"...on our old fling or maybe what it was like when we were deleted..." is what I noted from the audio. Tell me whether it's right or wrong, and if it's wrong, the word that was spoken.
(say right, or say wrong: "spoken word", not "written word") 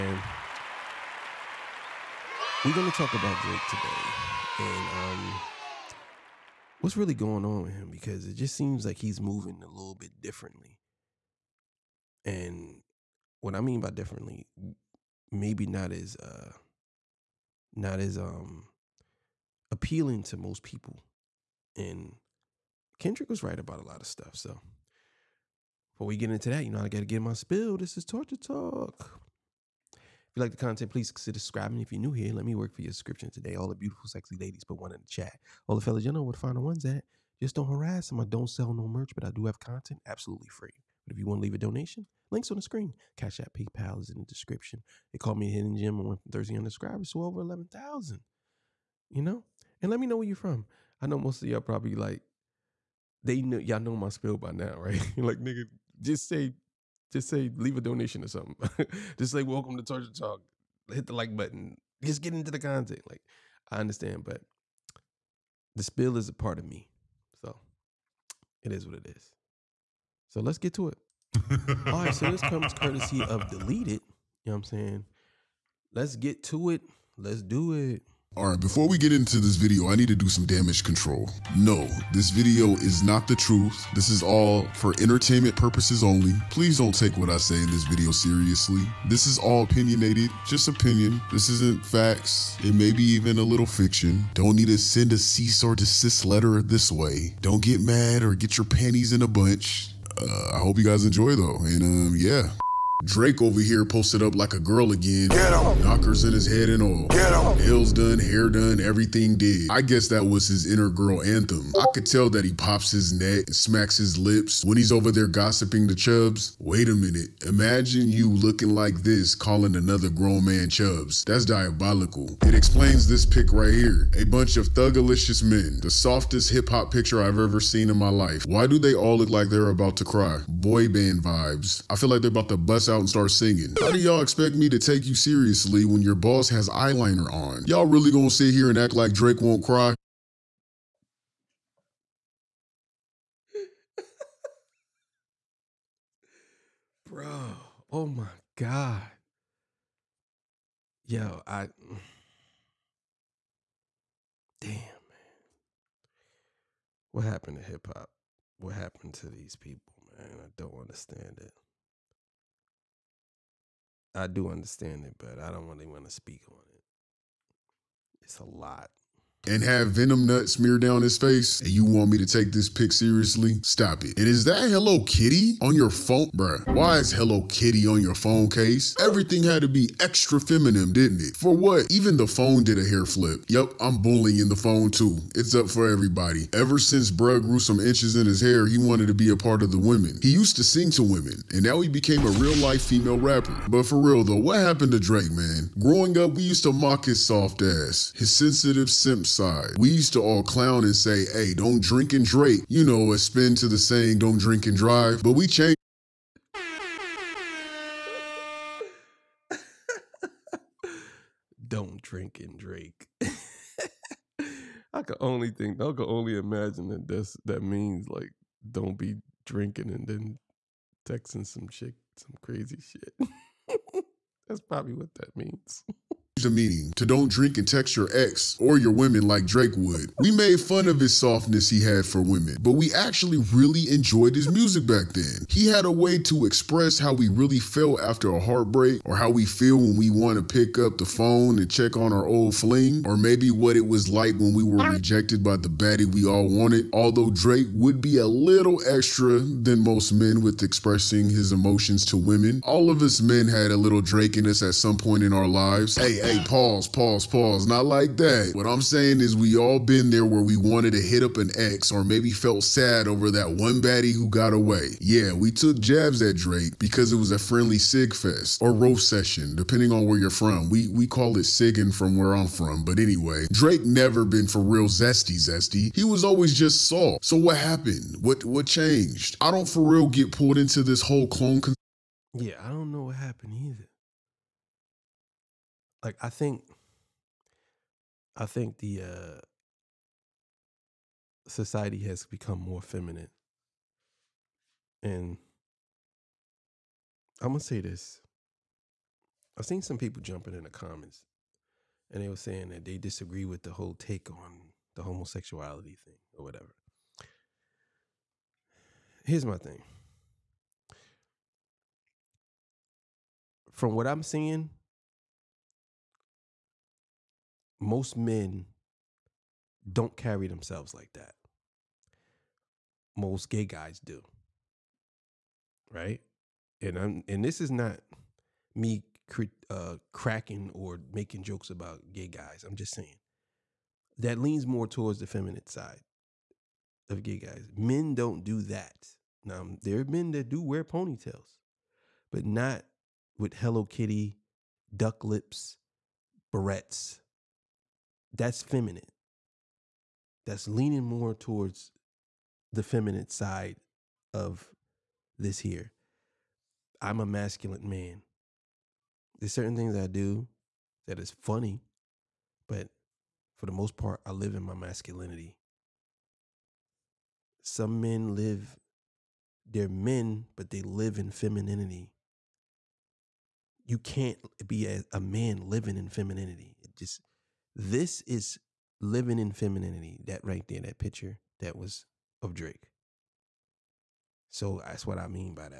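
wrong: "rejected", not "deleted".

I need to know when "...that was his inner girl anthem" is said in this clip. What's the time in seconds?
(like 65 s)
110 s.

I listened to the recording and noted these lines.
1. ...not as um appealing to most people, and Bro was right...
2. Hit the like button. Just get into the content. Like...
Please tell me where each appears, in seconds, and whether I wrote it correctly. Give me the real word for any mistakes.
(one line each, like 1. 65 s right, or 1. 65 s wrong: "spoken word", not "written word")
1. 17 s wrong: "Kendrick", not "Bro"
2. 60 s right.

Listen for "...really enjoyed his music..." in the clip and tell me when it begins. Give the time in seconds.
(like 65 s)
233 s.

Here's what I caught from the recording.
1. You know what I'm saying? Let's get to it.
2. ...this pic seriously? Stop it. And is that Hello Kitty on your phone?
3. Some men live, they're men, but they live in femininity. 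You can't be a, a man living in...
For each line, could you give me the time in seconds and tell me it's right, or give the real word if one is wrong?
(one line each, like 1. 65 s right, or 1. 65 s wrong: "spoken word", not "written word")
1. 74 s right
2. 172 s right
3. 367 s right.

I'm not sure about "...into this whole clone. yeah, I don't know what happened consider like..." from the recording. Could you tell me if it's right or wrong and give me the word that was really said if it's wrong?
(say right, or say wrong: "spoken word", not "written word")
wrong: "either", not "consider".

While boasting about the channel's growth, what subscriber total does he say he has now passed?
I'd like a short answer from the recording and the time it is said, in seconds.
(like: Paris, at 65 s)
11,000, at 47 s.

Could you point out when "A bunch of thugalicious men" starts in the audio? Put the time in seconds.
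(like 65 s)
124 s.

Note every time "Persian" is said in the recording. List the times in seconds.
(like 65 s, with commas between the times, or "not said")
not said.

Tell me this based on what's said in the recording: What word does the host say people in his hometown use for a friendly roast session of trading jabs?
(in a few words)
sigging.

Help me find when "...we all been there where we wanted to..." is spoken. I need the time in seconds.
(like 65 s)
259 s.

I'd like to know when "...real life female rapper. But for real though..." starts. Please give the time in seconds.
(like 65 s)
192 s.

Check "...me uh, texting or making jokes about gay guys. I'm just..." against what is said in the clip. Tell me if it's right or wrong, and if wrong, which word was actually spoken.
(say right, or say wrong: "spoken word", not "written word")
wrong: "cracking", not "texting".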